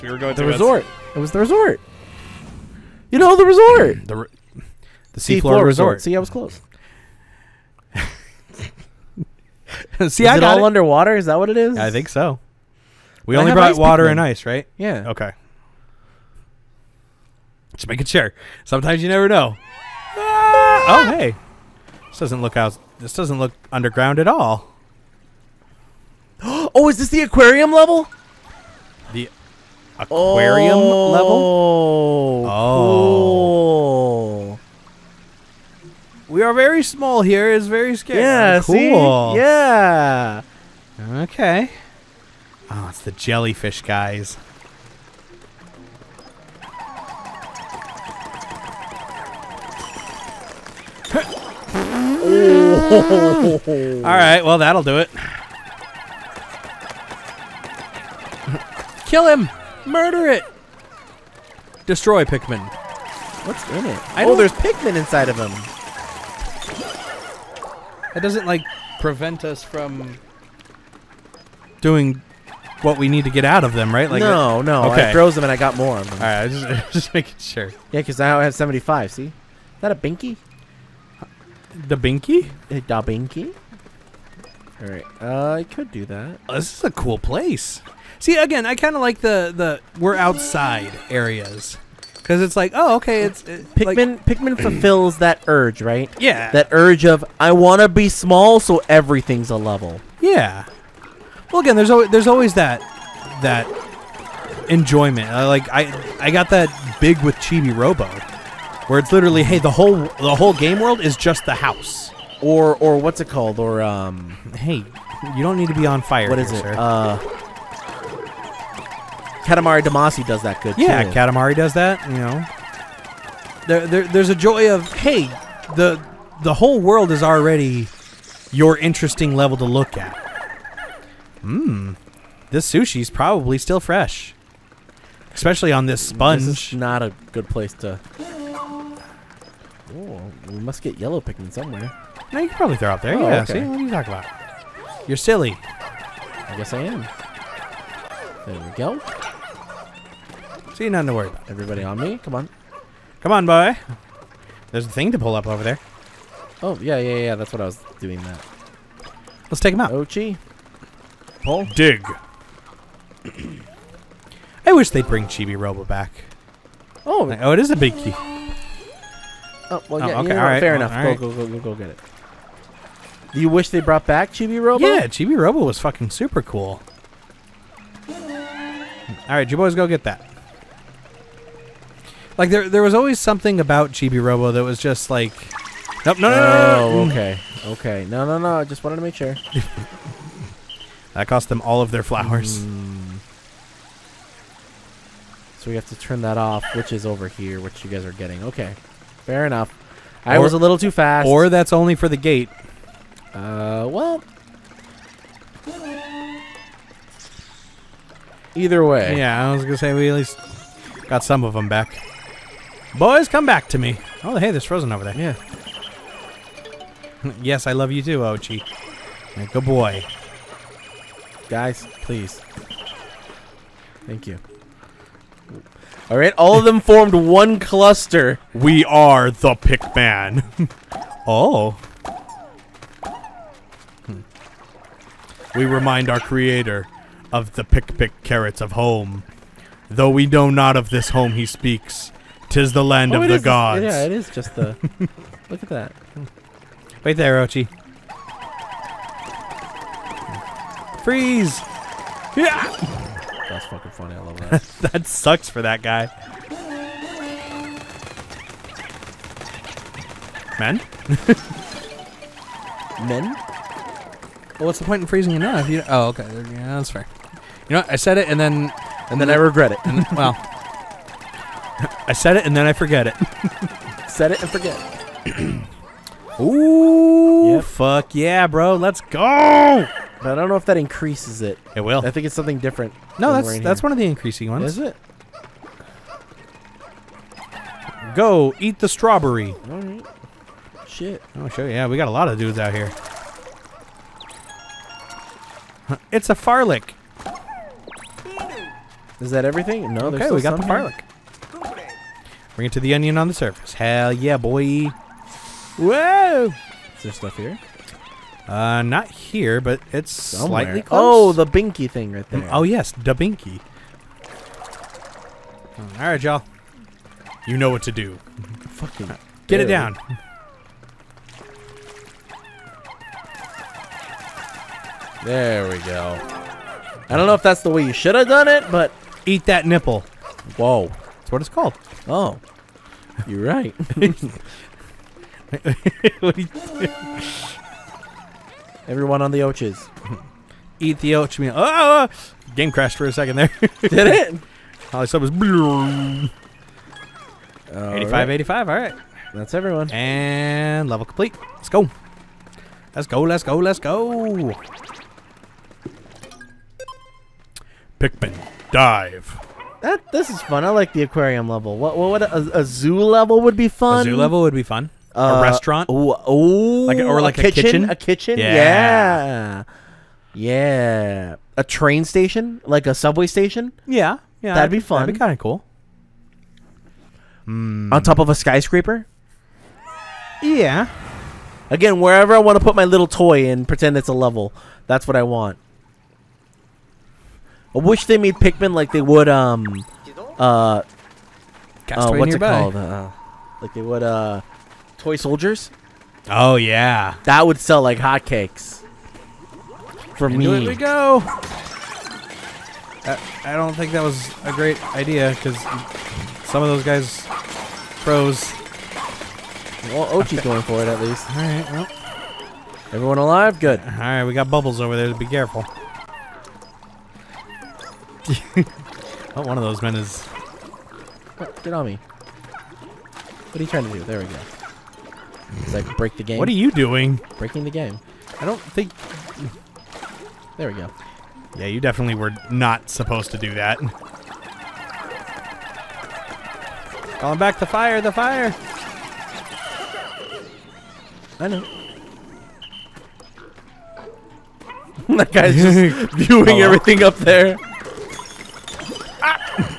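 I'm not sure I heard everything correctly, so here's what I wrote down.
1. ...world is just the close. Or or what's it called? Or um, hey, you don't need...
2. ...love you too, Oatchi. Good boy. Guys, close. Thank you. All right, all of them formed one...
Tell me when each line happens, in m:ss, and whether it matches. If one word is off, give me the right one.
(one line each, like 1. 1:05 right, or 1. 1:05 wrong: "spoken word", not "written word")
1. 1:50 wrong: "house", not "close"
2. 3:37 wrong: "please", not "close".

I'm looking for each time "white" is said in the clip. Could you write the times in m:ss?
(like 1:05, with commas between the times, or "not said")
not said.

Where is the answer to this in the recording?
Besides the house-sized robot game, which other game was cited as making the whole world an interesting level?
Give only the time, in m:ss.
1:59.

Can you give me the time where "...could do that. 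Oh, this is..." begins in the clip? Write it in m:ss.
1:25.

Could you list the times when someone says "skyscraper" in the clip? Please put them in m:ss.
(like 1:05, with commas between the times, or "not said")
6:18.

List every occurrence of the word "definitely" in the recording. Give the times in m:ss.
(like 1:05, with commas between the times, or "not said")
7:11.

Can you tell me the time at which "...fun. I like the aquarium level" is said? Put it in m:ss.
6:00.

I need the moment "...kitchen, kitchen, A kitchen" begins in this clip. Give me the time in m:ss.
6:07.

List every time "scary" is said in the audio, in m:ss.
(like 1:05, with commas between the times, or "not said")
0:37.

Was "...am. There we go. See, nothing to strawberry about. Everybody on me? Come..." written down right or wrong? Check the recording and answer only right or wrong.
wrong.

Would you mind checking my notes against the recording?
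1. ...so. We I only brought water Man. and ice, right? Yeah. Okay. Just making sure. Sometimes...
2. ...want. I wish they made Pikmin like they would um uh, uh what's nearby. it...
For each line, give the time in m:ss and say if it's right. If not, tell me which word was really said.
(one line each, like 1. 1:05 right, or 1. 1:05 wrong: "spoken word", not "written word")
1. 0:12 wrong: "Pikmin", not "Man"
2. 6:25 right.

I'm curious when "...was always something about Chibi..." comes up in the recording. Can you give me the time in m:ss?
3:02.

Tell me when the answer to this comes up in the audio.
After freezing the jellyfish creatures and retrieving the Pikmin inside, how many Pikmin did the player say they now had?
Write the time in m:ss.
1:18.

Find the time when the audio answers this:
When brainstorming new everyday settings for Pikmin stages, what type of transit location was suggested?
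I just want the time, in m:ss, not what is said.
6:12.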